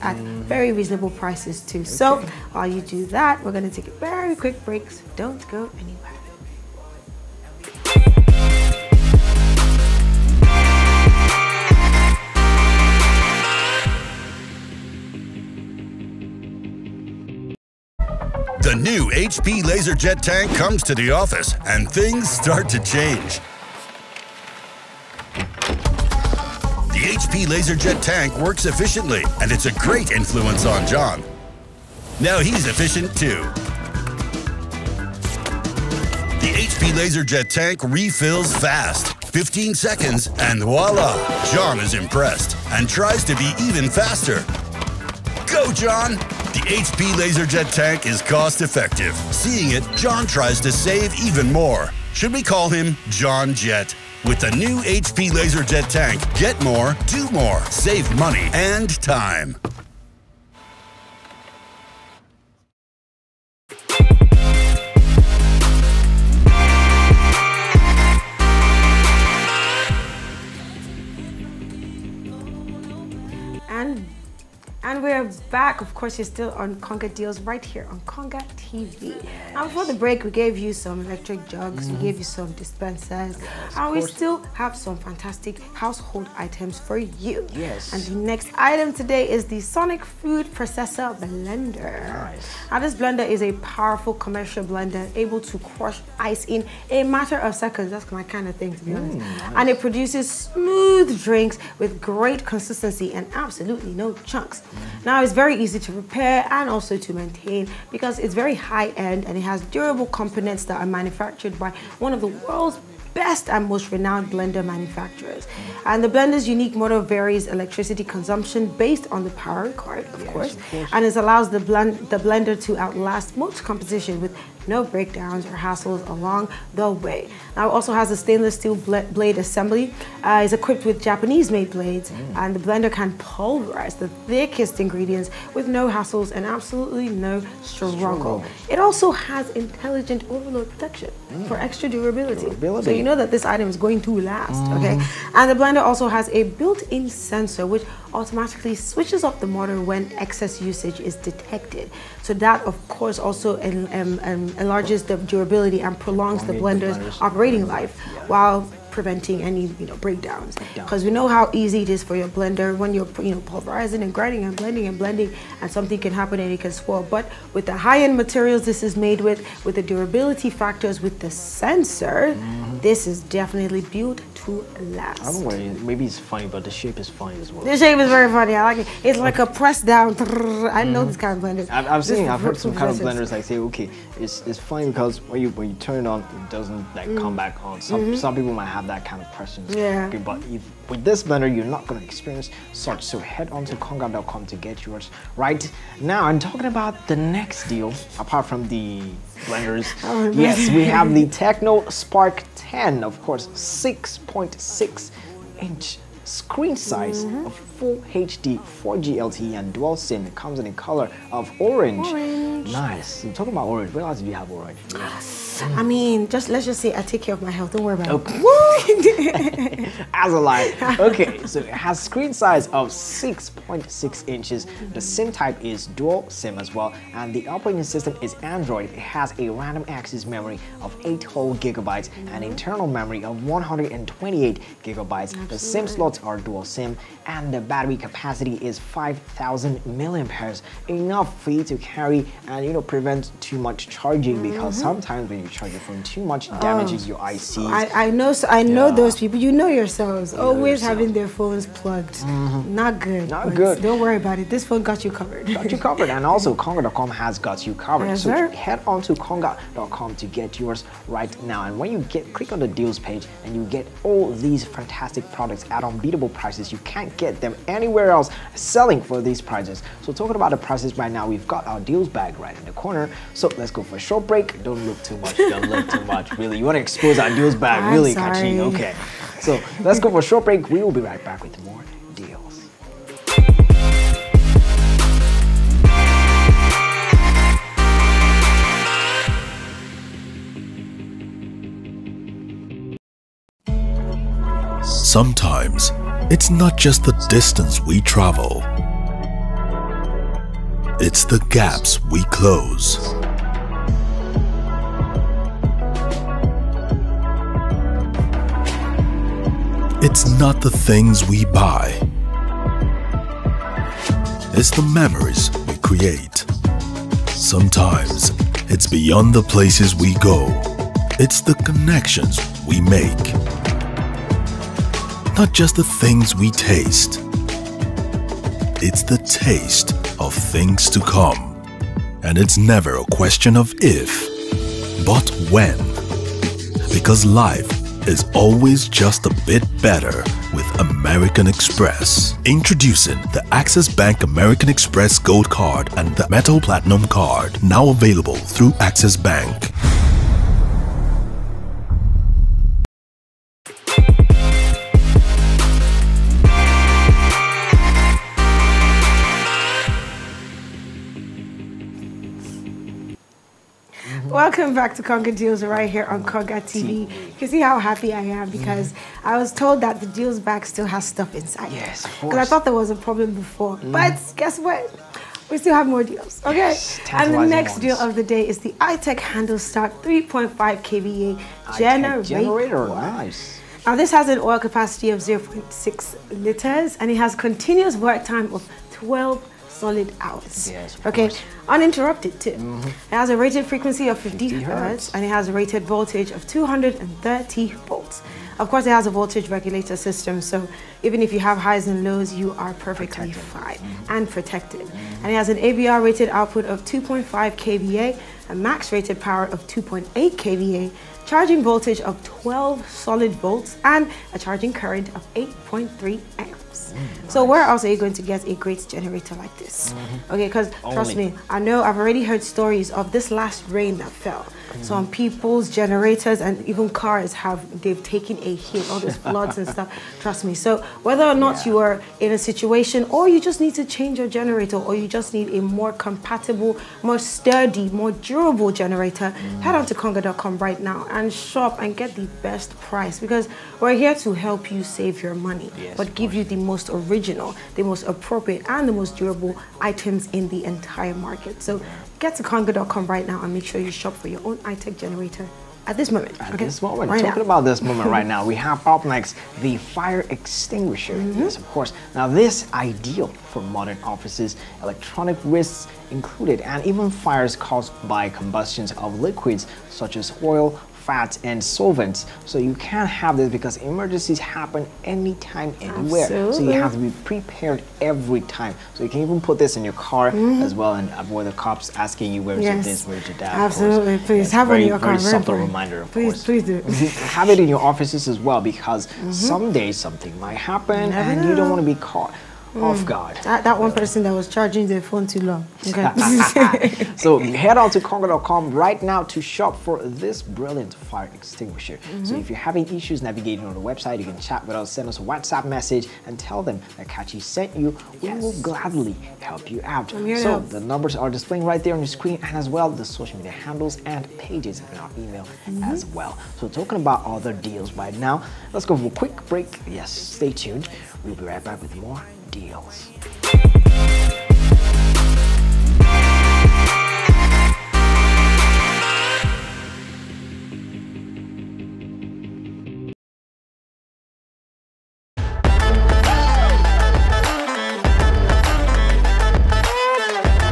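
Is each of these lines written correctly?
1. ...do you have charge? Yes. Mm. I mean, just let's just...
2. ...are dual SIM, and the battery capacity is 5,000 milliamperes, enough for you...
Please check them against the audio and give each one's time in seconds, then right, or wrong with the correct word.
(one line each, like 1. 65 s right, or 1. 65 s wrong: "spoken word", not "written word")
1. 214 s wrong: "orange", not "charge"
2. 236 s right.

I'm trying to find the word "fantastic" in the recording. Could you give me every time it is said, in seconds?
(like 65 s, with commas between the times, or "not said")
85 s, 264 s.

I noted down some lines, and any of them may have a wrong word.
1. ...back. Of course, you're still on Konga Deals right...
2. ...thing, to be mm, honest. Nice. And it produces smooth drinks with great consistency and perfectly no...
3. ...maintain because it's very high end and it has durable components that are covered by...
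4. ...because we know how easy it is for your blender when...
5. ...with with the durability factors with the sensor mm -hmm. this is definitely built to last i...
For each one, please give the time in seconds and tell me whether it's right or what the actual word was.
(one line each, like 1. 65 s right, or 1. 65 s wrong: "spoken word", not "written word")
1. 75 s right
2. 98 s wrong: "absolutely", not "perfectly"
3. 107 s wrong: "manufactured", not "covered"
4. 160 s right
5. 169 s right.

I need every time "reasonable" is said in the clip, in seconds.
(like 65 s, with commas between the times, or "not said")
0 s.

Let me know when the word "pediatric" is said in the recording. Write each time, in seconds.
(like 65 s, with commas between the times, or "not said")
not said.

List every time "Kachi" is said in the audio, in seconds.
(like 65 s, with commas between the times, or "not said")
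278 s, 507 s.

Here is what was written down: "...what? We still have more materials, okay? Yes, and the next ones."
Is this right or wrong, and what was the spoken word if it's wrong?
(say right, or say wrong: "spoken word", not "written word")
wrong: "deals", not "materials".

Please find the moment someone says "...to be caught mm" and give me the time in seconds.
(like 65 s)
491 s.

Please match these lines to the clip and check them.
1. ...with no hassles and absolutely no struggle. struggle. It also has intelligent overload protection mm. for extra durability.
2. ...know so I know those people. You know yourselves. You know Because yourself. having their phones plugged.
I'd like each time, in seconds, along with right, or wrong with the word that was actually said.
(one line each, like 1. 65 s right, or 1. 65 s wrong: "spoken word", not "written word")
1. 135 s right
2. 248 s wrong: "Always", not "Because".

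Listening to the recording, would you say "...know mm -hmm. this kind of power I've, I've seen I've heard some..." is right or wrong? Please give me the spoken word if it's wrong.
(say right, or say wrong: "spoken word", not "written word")
wrong: "blender", not "power".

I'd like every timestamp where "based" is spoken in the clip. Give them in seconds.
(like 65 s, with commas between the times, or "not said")
118 s.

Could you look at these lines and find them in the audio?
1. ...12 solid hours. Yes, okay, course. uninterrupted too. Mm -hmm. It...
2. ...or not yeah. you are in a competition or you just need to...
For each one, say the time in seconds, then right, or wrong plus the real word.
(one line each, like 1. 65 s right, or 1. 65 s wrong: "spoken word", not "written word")
1. 388 s right
2. 431 s wrong: "situation", not "competition".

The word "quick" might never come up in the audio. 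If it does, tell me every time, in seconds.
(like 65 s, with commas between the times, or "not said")
4 s, 519 s.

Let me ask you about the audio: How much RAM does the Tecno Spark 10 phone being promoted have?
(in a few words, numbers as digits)
8 gigabytes.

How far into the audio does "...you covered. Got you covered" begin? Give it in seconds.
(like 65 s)
255 s.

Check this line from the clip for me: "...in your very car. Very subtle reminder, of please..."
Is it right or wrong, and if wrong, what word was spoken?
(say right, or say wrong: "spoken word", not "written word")
right.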